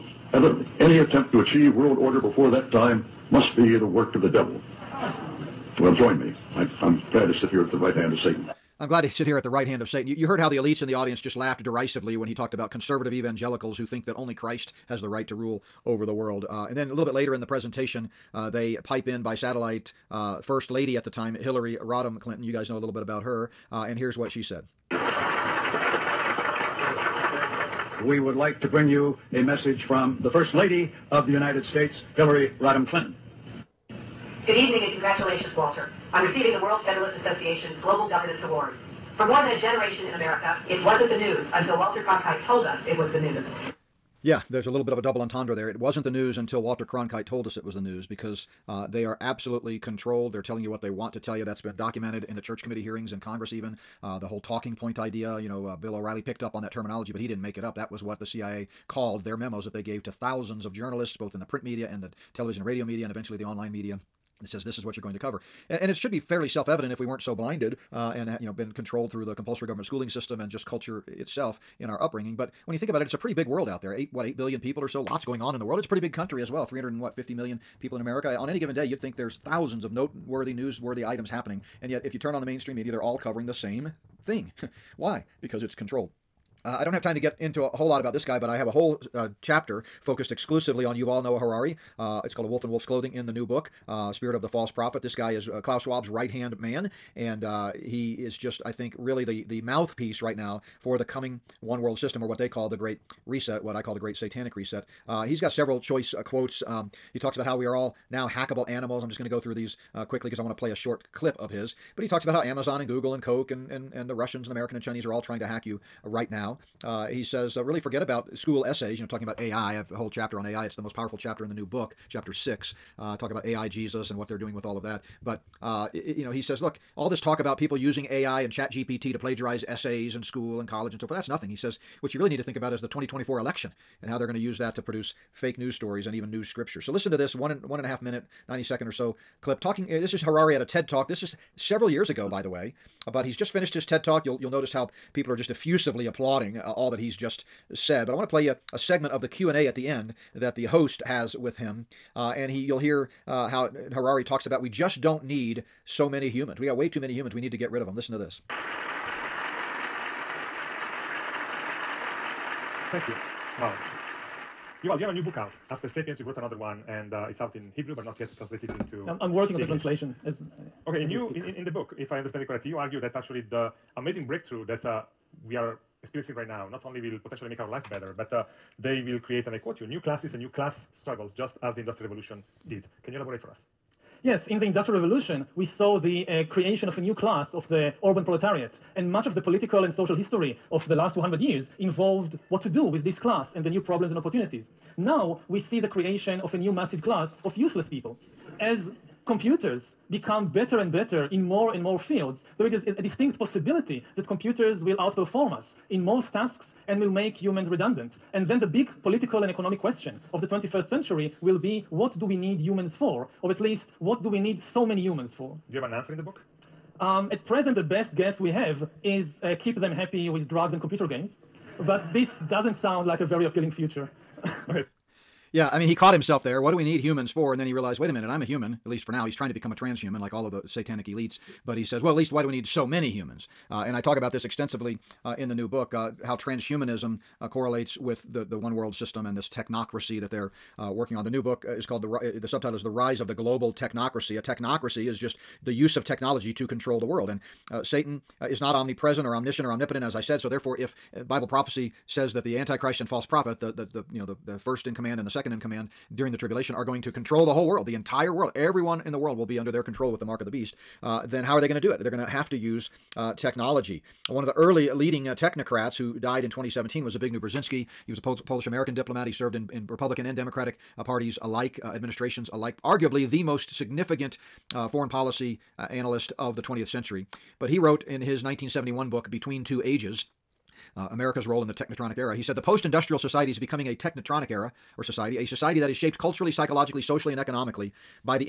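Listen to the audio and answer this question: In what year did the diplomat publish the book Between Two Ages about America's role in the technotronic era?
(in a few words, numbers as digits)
1971.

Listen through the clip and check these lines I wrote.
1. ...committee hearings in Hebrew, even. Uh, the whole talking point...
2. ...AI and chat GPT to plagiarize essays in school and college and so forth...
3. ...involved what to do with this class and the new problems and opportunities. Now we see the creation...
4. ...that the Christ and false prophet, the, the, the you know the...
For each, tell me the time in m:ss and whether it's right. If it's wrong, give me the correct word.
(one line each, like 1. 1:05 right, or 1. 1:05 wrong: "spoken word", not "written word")
1. 0:52 wrong: "Congress", not "Hebrew"
2. 2:08 right
3. 3:11 right
4. 4:12 wrong: "Antichrist", not "Christ".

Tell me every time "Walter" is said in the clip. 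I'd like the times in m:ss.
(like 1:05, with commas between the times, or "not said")
0:35, 0:41, 0:46.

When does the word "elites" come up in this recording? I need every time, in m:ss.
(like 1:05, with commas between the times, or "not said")
0:10, 3:51.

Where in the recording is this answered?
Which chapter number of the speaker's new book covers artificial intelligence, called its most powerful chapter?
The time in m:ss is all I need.
2:02.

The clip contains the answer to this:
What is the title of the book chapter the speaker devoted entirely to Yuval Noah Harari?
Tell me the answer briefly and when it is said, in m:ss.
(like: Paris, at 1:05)
A Wolf in Wolf's Clothing, at 1:32.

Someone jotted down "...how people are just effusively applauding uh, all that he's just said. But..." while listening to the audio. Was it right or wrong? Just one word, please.
right.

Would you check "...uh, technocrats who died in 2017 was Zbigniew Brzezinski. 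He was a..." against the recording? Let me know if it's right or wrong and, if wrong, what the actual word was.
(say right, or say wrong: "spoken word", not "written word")
right.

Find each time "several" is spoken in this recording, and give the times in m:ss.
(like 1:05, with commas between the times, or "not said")
1:45, 2:21.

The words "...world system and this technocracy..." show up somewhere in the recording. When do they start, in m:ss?
3:58.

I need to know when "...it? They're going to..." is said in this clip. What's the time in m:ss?
4:21.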